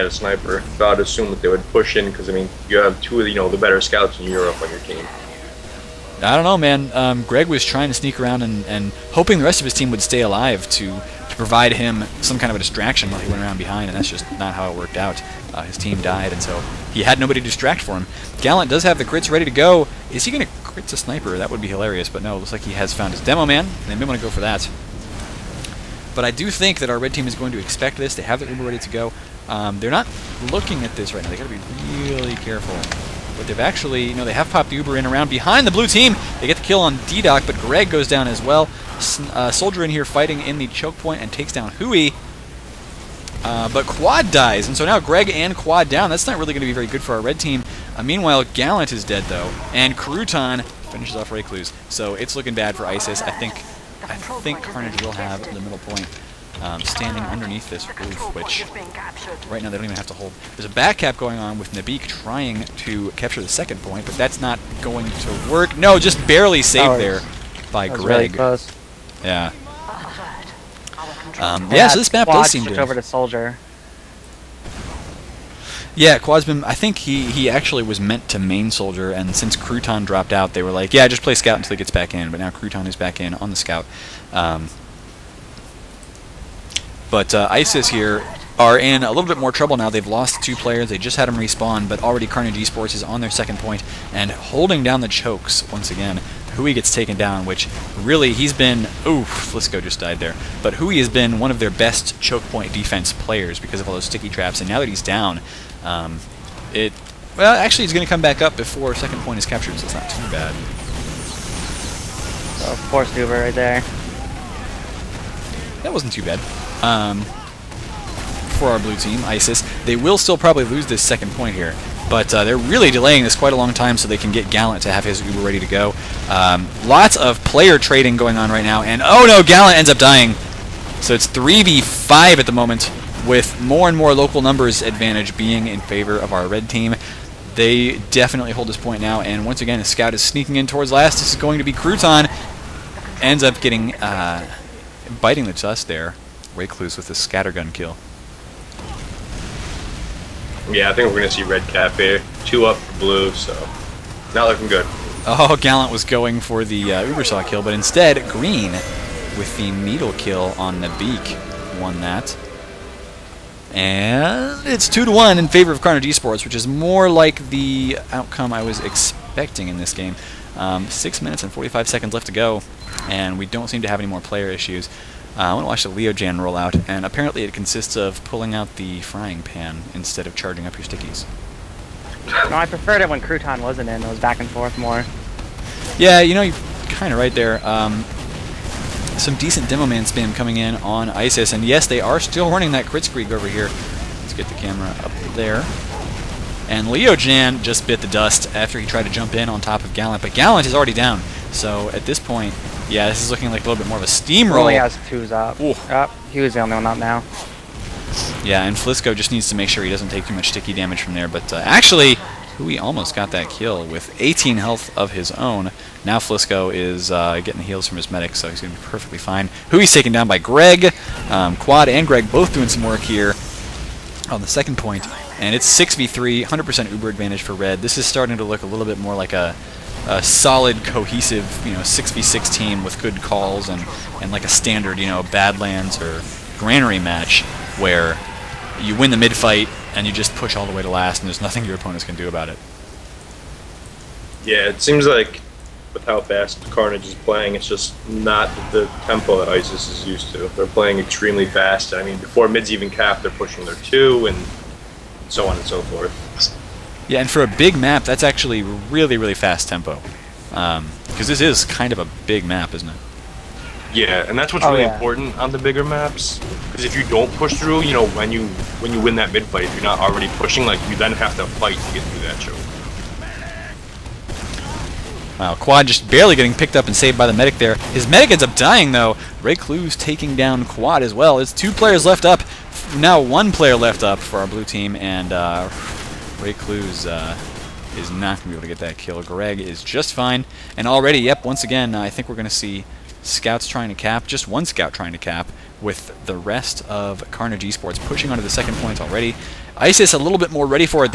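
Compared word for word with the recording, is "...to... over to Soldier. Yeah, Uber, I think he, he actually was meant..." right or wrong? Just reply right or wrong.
wrong.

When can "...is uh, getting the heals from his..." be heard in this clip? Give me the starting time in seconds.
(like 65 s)
216 s.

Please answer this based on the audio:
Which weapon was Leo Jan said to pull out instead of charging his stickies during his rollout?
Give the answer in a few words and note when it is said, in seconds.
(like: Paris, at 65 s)
Frying pan, at 179 s.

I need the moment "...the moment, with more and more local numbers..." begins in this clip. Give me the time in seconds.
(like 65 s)
132 s.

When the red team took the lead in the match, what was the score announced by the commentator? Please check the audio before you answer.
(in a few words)
2 to 1.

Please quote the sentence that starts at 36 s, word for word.
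They get the kill on D-Doc, but Greg goes down as well.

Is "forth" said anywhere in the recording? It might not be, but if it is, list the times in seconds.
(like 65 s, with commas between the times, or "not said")
184 s, 255 s.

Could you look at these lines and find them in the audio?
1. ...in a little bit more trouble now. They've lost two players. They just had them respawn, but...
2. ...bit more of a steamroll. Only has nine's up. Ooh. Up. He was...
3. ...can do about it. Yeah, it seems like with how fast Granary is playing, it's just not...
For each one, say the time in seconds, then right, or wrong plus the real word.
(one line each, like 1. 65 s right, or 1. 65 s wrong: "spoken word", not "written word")
1. 88 s right
2. 203 s wrong: "two", not "nine"
3. 242 s wrong: "Karnage", not "Granary".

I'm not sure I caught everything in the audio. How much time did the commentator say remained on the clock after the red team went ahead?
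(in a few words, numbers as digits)
6 minutes 45 seconds.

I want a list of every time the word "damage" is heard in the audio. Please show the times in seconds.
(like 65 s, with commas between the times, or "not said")
210 s.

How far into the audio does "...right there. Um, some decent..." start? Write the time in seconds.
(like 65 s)
187 s.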